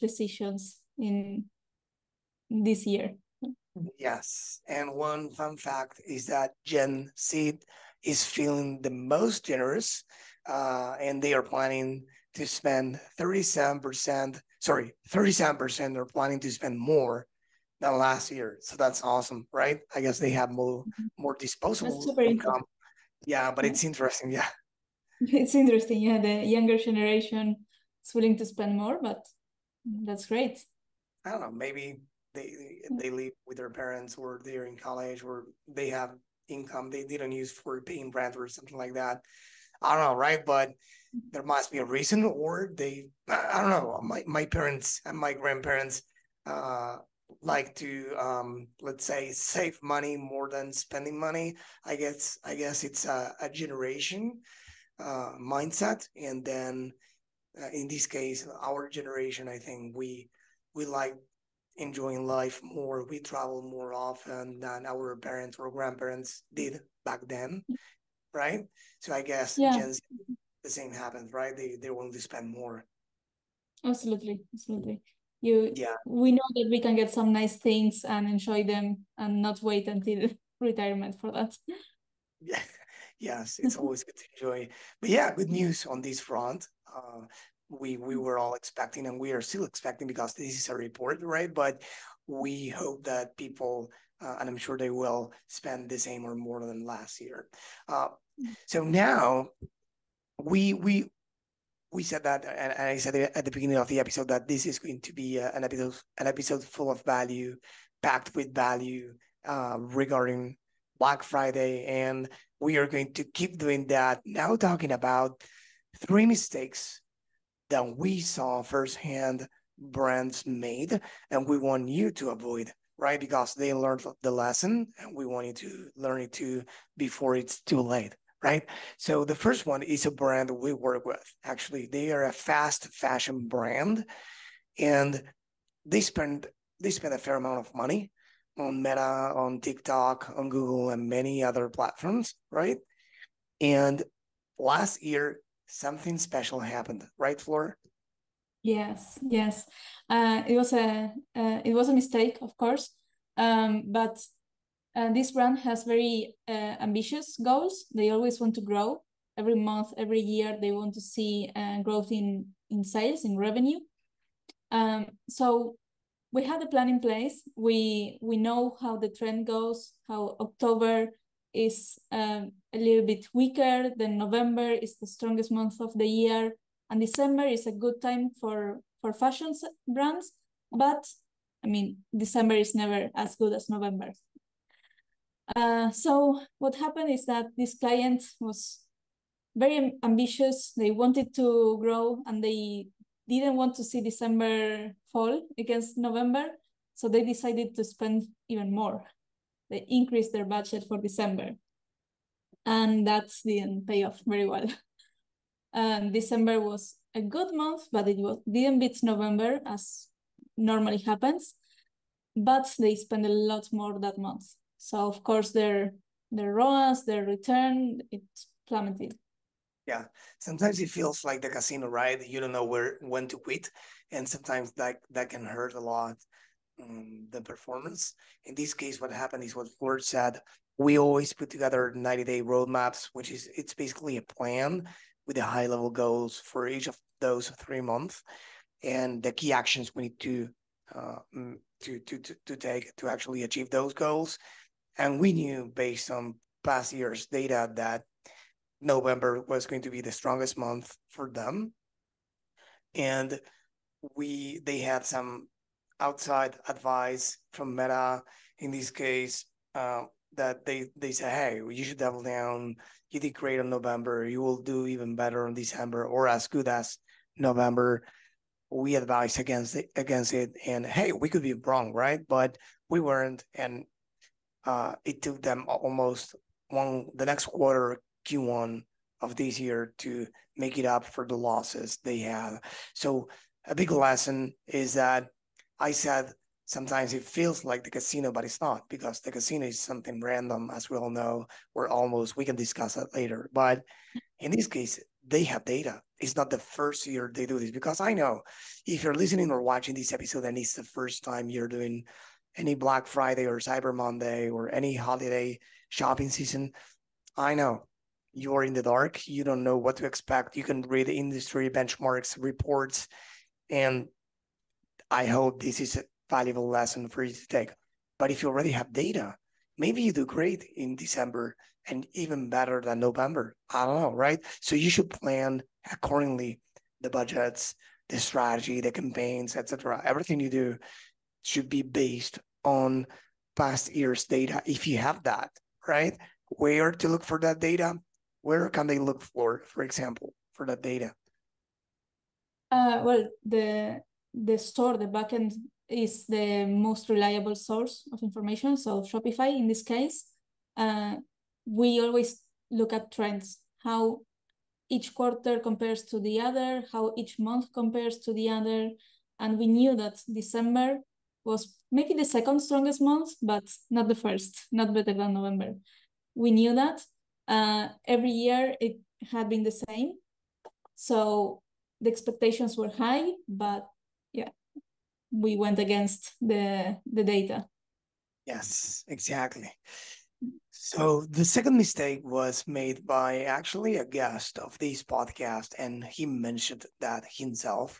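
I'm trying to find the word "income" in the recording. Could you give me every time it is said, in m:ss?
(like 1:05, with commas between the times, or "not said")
0:22, 0:36.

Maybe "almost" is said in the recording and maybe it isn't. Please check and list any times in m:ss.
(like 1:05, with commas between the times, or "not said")
4:35, 4:51.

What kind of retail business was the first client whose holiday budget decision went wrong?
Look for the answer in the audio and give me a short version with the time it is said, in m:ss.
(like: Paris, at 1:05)
fast fashion brand, at 2:12.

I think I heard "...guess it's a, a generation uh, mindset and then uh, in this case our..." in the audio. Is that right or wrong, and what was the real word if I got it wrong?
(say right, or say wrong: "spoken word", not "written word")
right.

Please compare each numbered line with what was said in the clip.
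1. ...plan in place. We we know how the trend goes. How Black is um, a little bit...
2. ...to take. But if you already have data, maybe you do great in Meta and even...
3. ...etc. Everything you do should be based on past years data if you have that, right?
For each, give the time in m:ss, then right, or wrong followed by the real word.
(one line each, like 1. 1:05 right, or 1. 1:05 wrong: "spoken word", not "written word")
1. 2:46 wrong: "October", not "Black"
2. 5:17 wrong: "December", not "Meta"
3. 5:29 right.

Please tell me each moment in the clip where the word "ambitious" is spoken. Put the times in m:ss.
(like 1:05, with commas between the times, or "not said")
2:36, 3:10.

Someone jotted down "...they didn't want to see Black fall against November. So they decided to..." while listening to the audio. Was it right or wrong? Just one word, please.
wrong.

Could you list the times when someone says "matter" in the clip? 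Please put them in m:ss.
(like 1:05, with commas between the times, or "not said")
not said.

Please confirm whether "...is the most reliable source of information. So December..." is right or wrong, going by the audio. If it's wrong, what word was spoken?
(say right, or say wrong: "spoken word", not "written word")
wrong: "Shopify", not "December".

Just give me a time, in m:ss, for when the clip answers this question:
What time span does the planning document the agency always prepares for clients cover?
3:51.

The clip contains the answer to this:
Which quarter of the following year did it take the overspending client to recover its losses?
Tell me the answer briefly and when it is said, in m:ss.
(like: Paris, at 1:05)
Q1, at 4:38.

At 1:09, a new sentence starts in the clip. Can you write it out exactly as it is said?
Gen Z, the same happens right they they want to spend more absolutely absolutely you yeah.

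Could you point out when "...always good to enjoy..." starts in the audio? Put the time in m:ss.
1:23.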